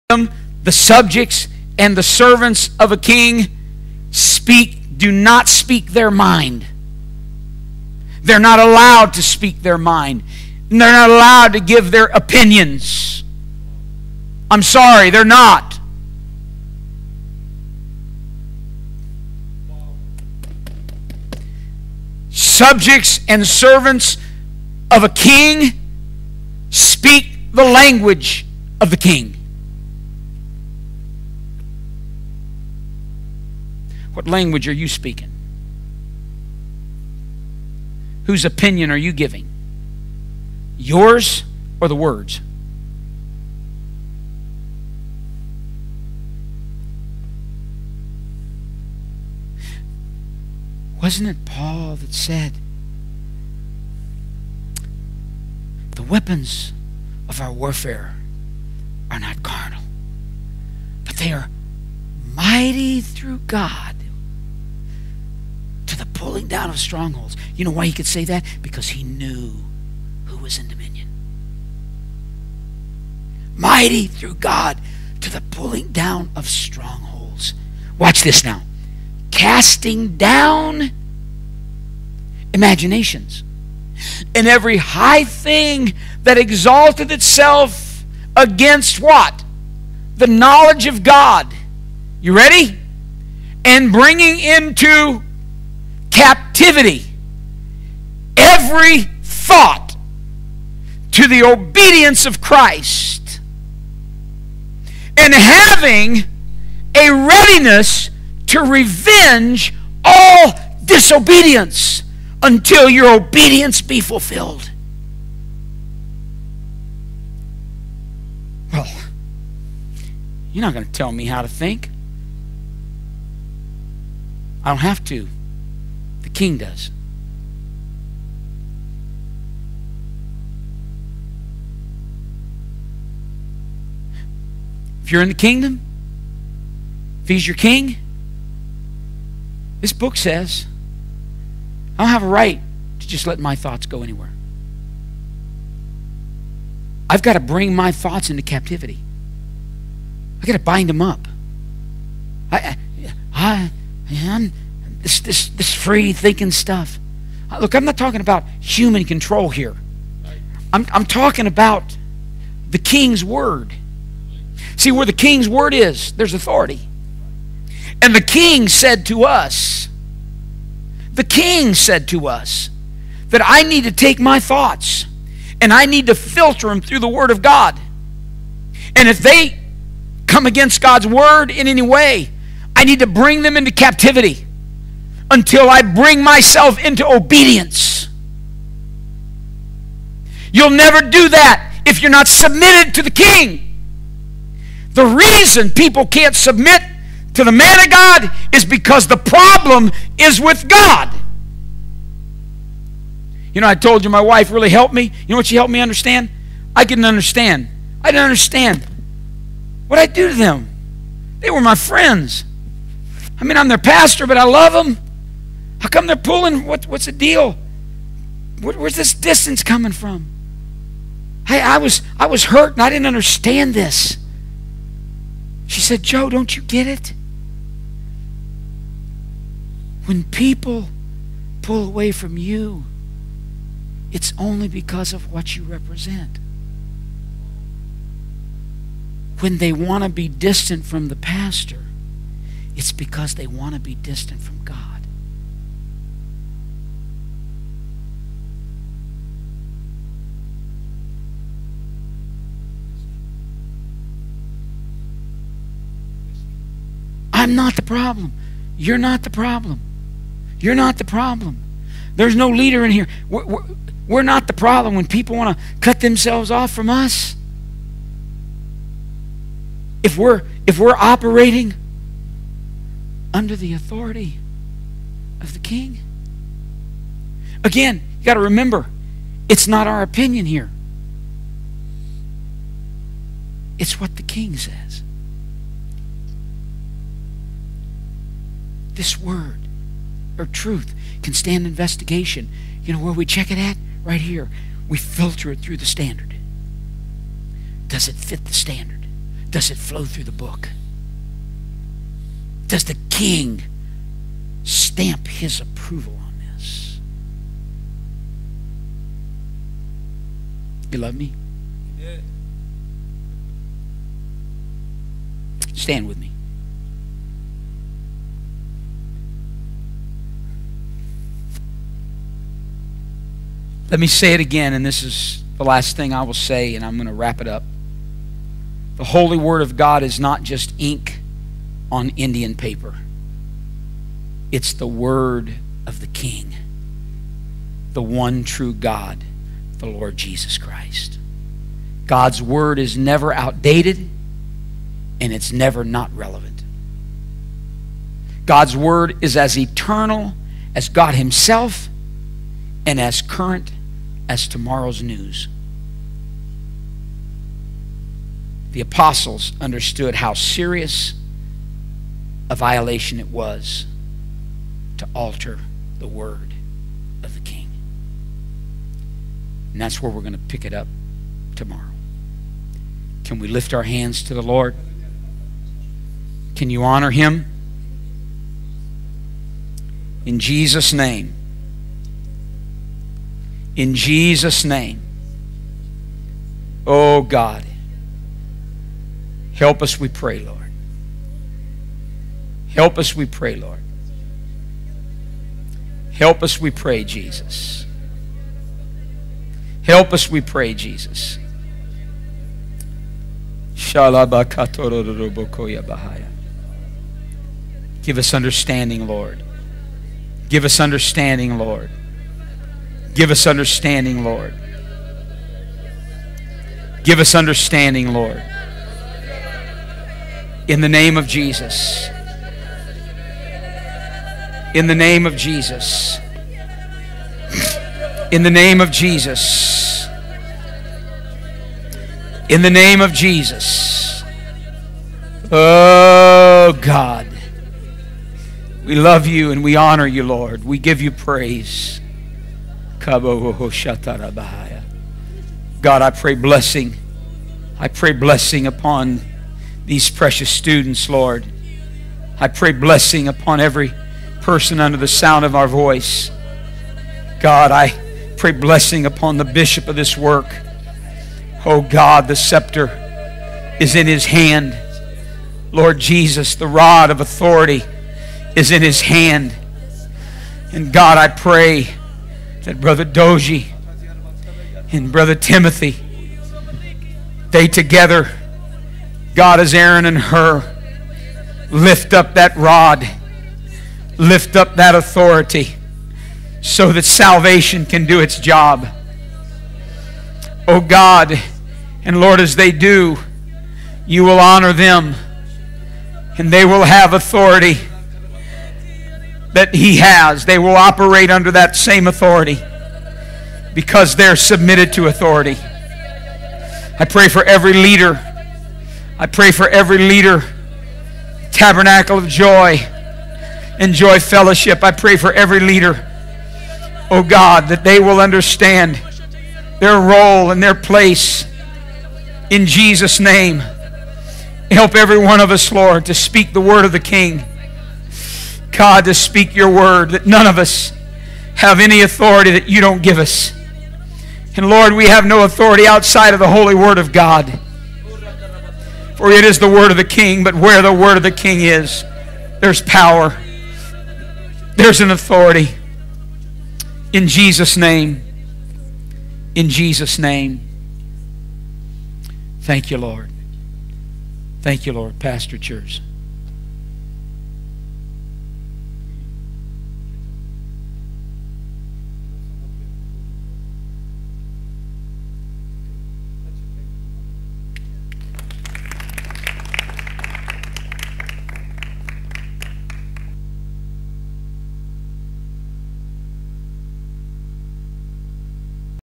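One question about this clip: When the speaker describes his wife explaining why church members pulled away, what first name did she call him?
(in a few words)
Joe.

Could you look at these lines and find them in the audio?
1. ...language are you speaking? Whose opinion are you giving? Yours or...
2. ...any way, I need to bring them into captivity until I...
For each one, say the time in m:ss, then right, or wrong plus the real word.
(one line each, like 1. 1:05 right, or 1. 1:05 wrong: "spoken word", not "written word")
1. 0:34 right
2. 3:01 right.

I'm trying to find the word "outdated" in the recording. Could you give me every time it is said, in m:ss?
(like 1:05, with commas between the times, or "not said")
5:43.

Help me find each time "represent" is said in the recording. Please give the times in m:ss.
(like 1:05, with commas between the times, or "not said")
3:55.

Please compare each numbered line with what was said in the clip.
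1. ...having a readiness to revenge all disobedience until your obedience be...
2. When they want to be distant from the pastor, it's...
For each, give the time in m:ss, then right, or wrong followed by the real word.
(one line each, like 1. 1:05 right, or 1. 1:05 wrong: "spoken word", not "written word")
1. 1:45 right
2. 3:59 right.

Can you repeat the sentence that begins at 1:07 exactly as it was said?
You know why he could say that?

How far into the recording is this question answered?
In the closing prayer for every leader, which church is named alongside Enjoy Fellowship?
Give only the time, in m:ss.
8:31.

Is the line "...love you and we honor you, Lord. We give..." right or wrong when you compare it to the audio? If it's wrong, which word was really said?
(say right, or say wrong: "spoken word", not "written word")
right.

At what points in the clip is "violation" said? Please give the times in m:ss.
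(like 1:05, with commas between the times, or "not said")
6:02.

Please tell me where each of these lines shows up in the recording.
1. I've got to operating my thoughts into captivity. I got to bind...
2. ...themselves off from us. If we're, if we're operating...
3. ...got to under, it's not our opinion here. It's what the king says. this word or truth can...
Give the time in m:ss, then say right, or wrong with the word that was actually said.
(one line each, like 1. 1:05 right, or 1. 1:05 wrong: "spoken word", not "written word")
1. 2:27 wrong: "bring", not "operating"
2. 4:26 right
3. 4:38 wrong: "remember", not "under".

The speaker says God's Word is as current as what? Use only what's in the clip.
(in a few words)
tomorrow's news.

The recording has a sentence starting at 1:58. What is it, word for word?
Well, you're not going to tell me how to think.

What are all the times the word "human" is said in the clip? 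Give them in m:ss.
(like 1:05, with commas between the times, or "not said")
2:38.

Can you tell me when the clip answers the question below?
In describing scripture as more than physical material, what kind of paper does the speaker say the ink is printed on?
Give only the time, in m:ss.
5:32.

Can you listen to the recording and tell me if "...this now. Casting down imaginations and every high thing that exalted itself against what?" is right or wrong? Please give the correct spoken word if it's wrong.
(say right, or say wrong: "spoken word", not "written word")
right.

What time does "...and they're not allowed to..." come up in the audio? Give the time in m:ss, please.
0:10.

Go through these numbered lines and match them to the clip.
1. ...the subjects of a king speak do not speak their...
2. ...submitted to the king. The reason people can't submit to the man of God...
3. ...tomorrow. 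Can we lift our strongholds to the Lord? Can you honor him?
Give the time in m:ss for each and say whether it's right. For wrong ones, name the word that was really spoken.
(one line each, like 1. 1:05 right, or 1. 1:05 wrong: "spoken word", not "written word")
1. 0:01 wrong: "servants", not "subjects"
2. 3:12 right
3. 6:11 wrong: "hands", not "strongholds".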